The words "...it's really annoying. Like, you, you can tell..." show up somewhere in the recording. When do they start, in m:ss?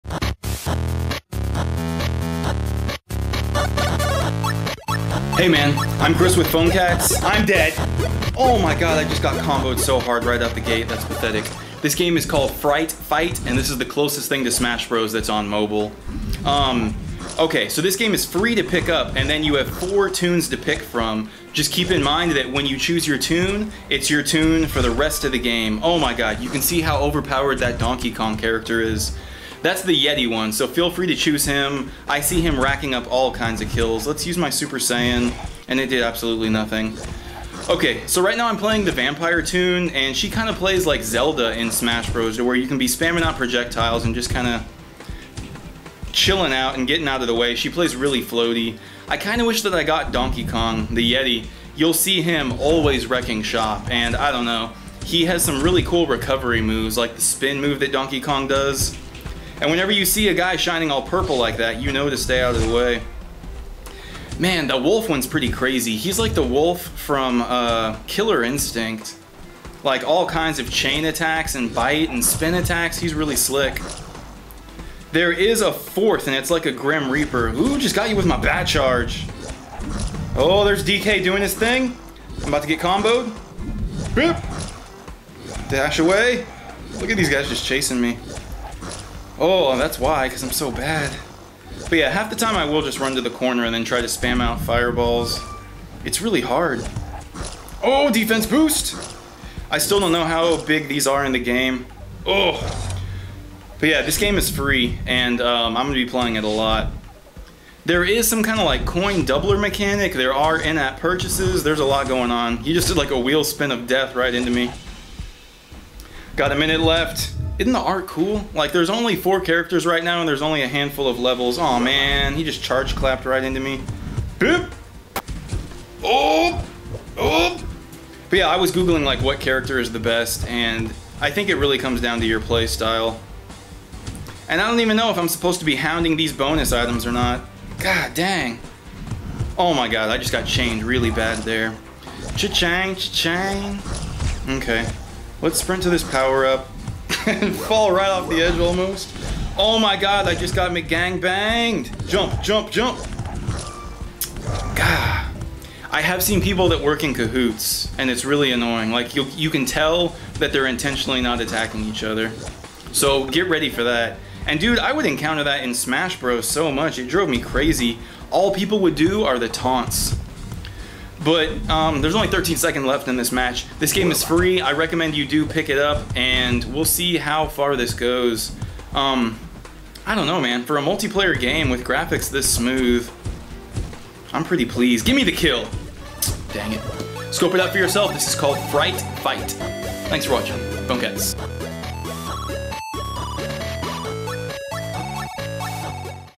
2:38.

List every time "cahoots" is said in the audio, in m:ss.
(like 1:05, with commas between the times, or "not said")
2:37.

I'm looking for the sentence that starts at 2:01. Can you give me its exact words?
Oh man, he just charge clapped right into me.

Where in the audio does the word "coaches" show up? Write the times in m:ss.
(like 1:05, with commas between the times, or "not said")
not said.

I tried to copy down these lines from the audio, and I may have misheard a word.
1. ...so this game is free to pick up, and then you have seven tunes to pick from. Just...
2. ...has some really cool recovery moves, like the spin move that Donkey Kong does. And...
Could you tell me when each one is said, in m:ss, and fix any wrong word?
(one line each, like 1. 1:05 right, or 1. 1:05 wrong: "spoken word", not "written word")
1. 0:17 wrong: "four", not "seven"
2. 0:55 right.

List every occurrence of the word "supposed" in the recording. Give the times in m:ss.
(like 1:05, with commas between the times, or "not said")
2:15.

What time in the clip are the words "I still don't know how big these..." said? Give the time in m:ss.
1:39.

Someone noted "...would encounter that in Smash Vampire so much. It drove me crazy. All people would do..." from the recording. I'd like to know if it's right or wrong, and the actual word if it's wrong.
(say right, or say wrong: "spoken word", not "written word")
wrong: "Bros", not "Vampire".